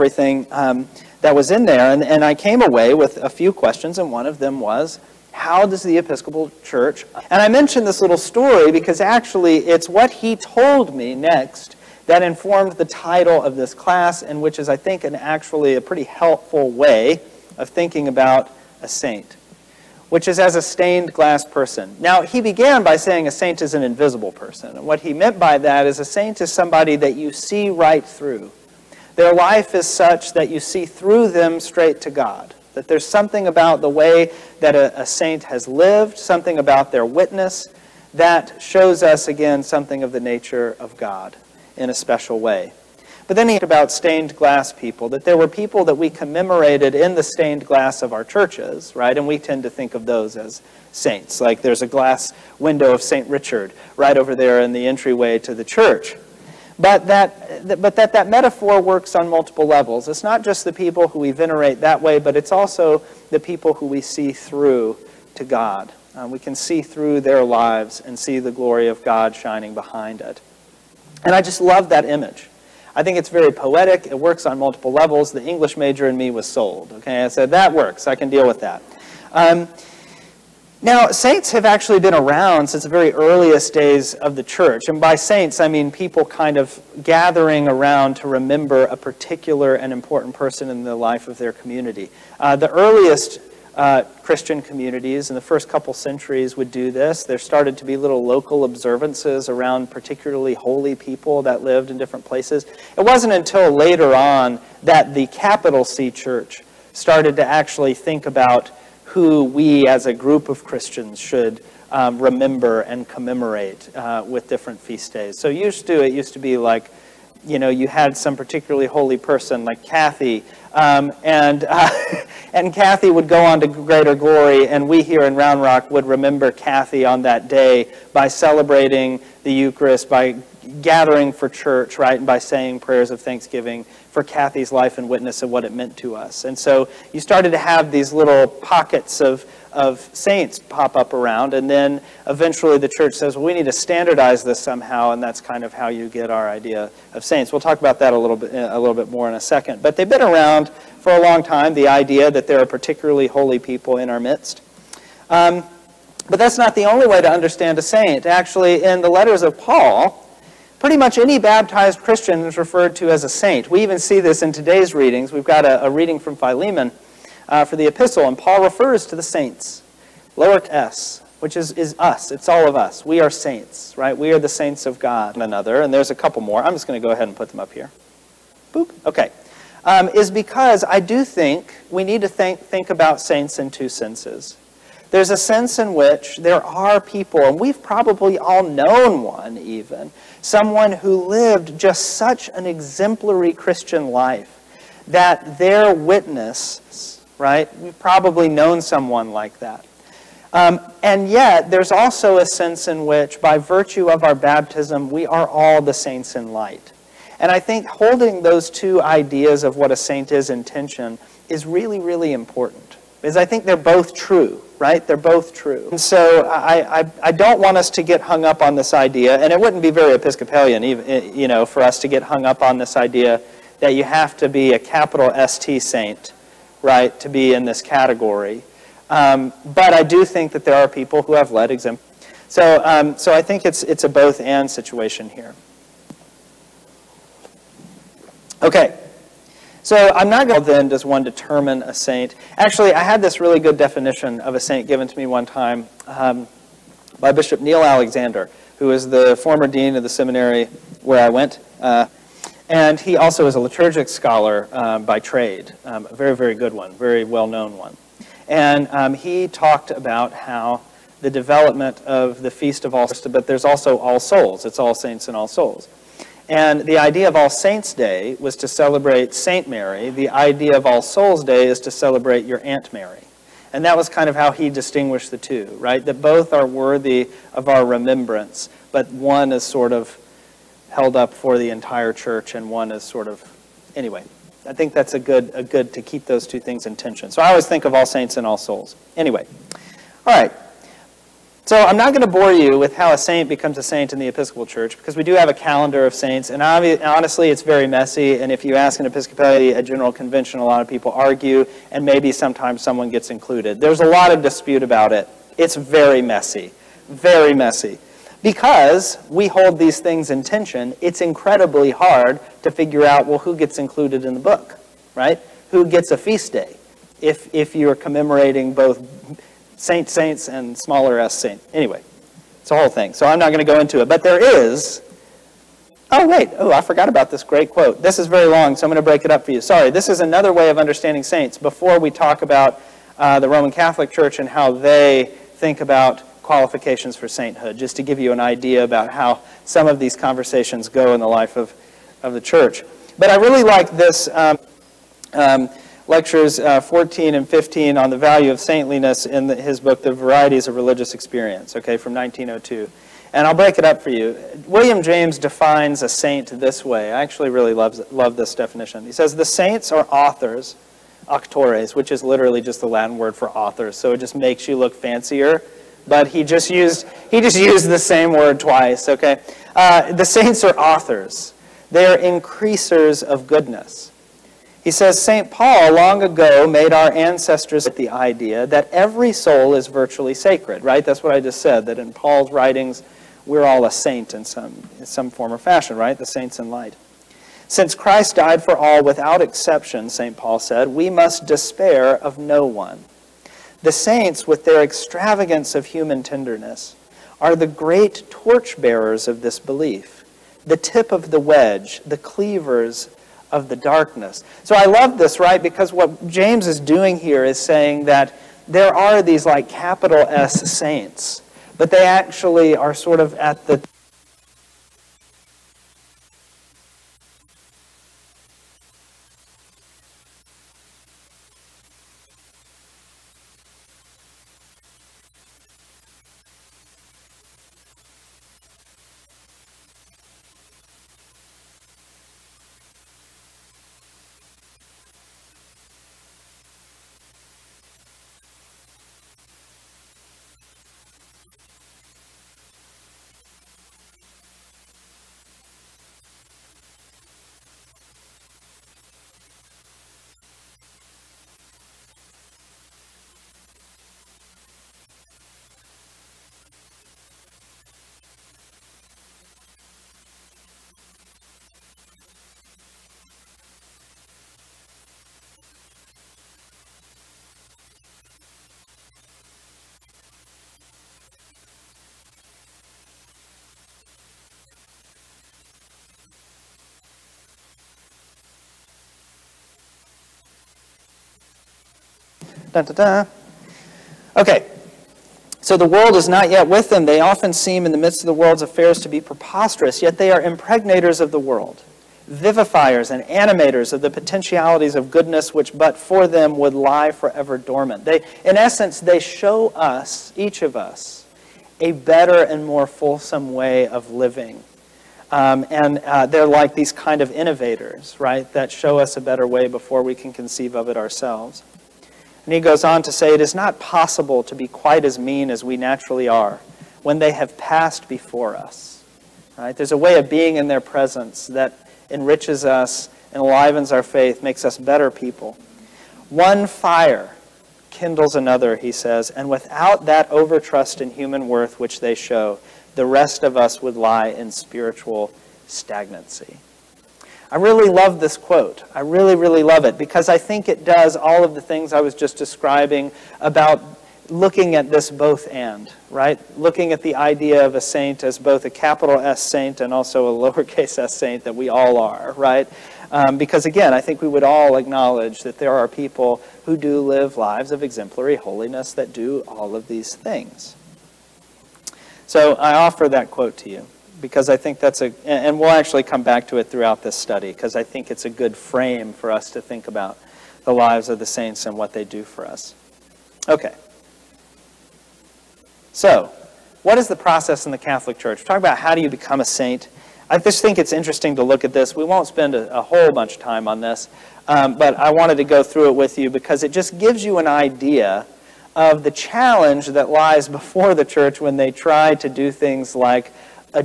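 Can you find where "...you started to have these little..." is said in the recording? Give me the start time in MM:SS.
02:17.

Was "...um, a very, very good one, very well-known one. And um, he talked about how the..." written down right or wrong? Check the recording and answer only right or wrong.
right.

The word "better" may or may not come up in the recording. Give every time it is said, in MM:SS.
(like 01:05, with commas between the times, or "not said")
08:21, 08:29, 08:44.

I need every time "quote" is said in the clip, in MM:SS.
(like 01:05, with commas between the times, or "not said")
05:27, 08:58, 09:23.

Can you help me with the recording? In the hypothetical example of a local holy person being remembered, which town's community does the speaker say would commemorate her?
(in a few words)
Round Rock.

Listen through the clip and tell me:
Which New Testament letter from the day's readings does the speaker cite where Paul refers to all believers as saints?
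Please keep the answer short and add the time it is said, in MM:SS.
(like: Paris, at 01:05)
Philemon, at 02:46.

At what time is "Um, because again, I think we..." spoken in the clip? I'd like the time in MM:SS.
09:13.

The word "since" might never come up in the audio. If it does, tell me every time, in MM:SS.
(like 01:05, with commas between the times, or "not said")
01:22, 06:27.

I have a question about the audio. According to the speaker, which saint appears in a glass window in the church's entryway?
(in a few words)
St. Richard.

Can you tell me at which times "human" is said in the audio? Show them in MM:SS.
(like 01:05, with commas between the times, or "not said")
06:35, 08:51.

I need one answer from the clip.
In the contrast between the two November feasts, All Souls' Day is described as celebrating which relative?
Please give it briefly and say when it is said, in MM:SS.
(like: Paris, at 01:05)
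Your Aunt Mary, at 04:32.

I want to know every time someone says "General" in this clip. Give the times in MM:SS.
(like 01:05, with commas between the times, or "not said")
04:59.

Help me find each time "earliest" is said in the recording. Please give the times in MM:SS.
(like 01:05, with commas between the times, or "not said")
01:23, 01:32.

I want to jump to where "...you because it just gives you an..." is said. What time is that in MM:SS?
09:46.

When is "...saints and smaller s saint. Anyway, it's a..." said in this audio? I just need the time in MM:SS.
05:20.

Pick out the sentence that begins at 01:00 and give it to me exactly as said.
It's not just the people who we venerate that way, but it's also the people who we see through to God.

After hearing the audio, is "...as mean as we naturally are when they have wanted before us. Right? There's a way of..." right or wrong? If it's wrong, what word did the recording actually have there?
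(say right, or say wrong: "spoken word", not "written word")
wrong: "passed", not "wanted".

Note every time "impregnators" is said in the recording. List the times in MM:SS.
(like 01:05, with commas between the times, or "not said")
08:10.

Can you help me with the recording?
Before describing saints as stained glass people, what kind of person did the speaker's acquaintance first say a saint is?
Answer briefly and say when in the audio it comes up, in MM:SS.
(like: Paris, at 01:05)
An invisible person, at 00:23.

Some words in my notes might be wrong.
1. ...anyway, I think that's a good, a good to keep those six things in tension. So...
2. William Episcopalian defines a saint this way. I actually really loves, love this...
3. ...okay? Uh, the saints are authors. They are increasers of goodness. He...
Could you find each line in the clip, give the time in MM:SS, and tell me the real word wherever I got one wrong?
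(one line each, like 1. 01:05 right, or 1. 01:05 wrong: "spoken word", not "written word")
1. 04:43 wrong: "two", not "six"
2. 05:54 wrong: "James", not "Episcopalian"
3. 06:09 right.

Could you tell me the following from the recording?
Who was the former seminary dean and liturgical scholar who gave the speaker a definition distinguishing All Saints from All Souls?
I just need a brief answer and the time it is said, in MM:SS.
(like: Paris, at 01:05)
Neil Alexander, at 04:07.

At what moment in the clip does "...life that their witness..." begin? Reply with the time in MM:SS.
03:14.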